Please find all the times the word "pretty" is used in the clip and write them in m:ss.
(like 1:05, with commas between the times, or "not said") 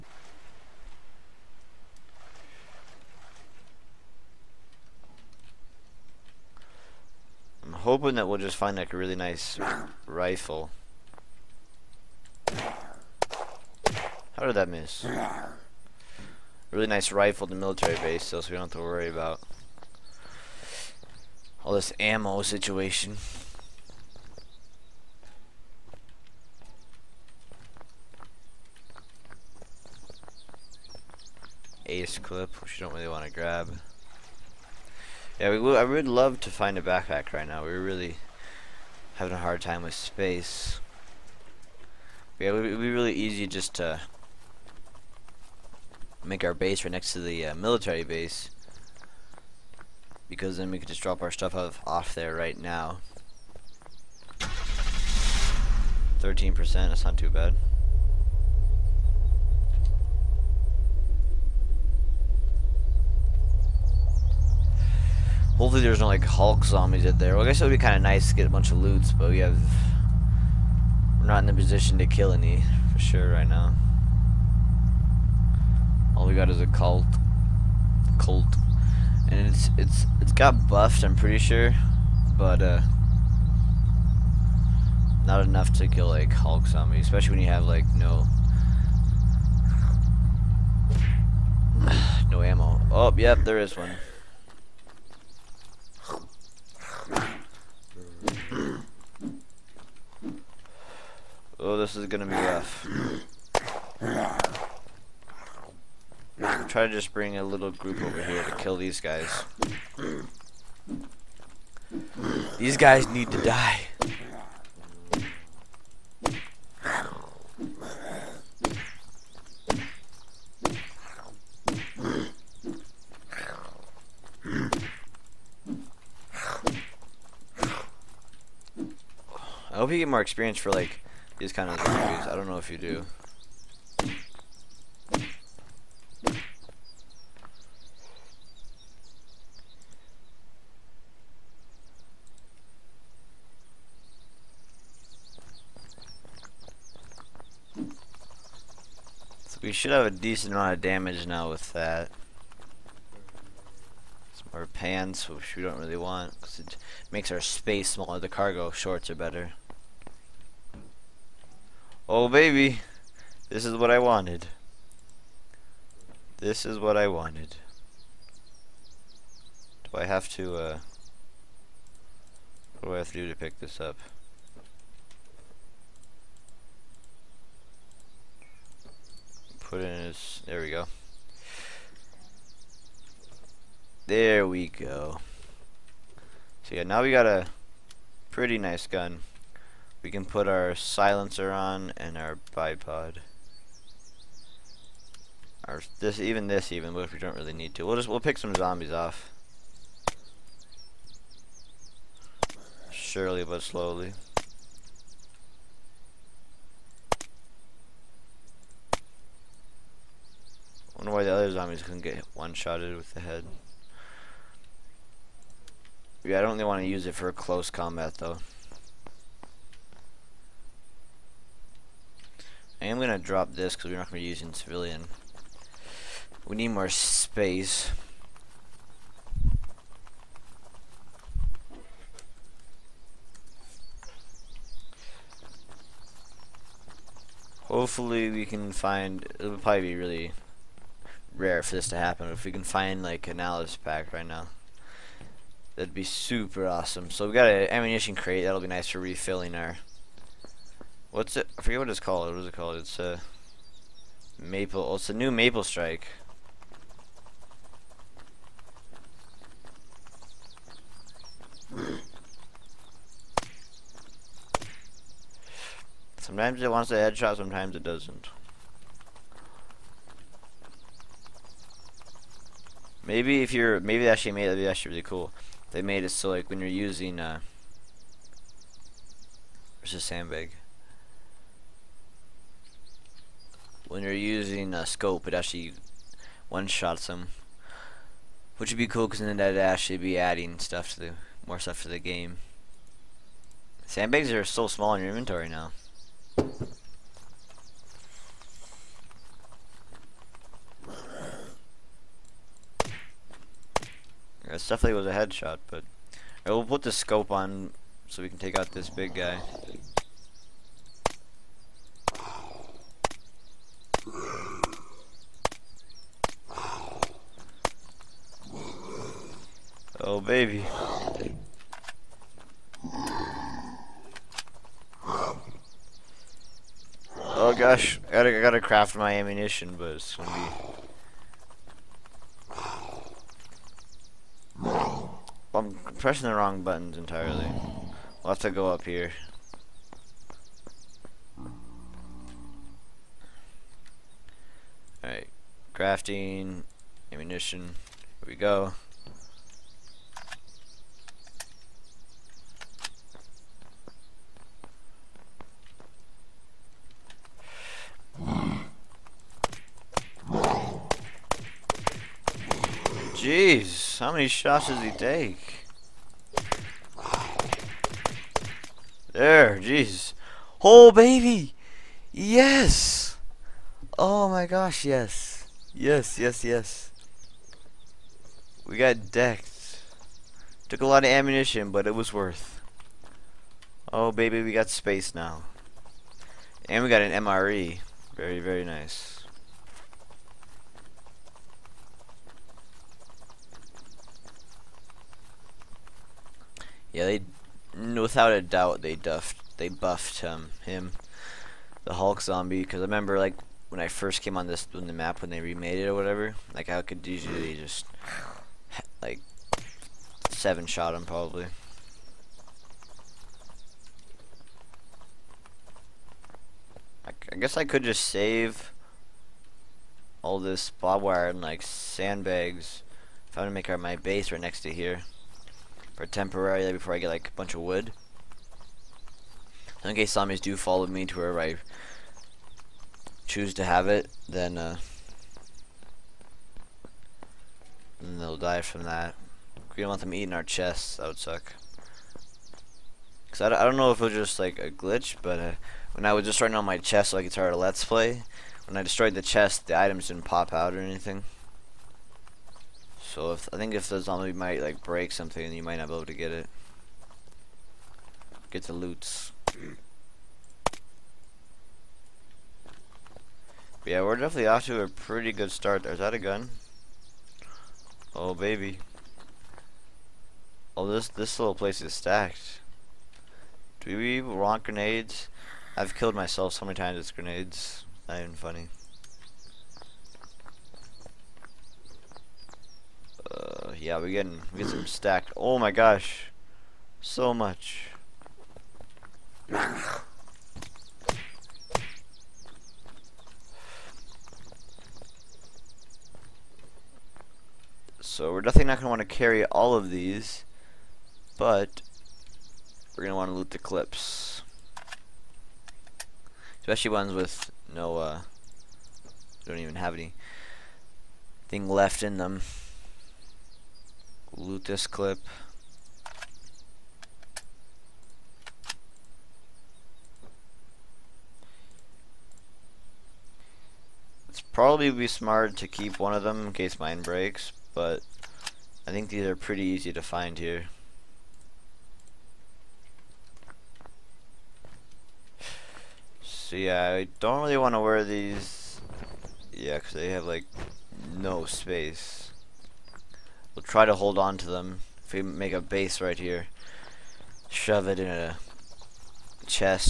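1:21, 3:08, 7:44, 8:49.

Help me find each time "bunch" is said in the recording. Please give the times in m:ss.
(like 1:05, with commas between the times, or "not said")
1:08, 7:07.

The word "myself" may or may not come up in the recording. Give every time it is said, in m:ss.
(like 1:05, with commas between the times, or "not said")
7:56.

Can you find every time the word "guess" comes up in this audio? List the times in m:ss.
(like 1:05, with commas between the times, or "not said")
1:07, 6:57.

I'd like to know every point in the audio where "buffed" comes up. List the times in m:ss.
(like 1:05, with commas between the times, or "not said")
1:20, 6:39.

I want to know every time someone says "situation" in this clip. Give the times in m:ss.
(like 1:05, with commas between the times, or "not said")
0:22.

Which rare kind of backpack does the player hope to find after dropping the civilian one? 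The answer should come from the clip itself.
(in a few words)
Alice pack.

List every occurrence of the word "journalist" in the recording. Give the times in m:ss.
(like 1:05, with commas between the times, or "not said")
not said.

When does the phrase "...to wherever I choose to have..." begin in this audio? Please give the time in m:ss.
7:11.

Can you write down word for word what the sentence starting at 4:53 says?
Sandbags are so small in your inventory now.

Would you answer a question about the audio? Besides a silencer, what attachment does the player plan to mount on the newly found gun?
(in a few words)
Bipod.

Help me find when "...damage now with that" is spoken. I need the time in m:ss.
2:30.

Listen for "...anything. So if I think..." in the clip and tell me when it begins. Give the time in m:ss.
7:30.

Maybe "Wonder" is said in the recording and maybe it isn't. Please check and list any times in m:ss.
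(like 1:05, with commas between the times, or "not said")
3:30.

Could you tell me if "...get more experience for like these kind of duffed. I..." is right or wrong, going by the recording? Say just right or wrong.
wrong.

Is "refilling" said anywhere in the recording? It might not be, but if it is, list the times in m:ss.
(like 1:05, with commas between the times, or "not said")
4:08.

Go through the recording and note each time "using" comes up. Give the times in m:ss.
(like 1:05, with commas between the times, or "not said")
3:44, 4:36, 4:44.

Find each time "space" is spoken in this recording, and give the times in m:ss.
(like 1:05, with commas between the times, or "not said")
0:39, 2:37, 3:46, 6:24, 9:01.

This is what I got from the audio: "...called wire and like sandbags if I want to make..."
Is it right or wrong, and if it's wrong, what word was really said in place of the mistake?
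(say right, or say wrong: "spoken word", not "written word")
wrong: "barbed", not "called".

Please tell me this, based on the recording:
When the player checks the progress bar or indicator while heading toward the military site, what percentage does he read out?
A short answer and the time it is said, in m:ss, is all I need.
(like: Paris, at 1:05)
13%, at 0:56.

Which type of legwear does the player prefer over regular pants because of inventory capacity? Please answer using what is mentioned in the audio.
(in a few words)
Cargo shorts.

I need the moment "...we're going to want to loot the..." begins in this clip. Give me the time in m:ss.
8:22.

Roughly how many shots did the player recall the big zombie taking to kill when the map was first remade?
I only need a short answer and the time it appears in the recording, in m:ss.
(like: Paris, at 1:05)
7, at 6:50.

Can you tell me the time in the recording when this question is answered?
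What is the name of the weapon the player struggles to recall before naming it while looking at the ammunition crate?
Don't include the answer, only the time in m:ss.
4:15.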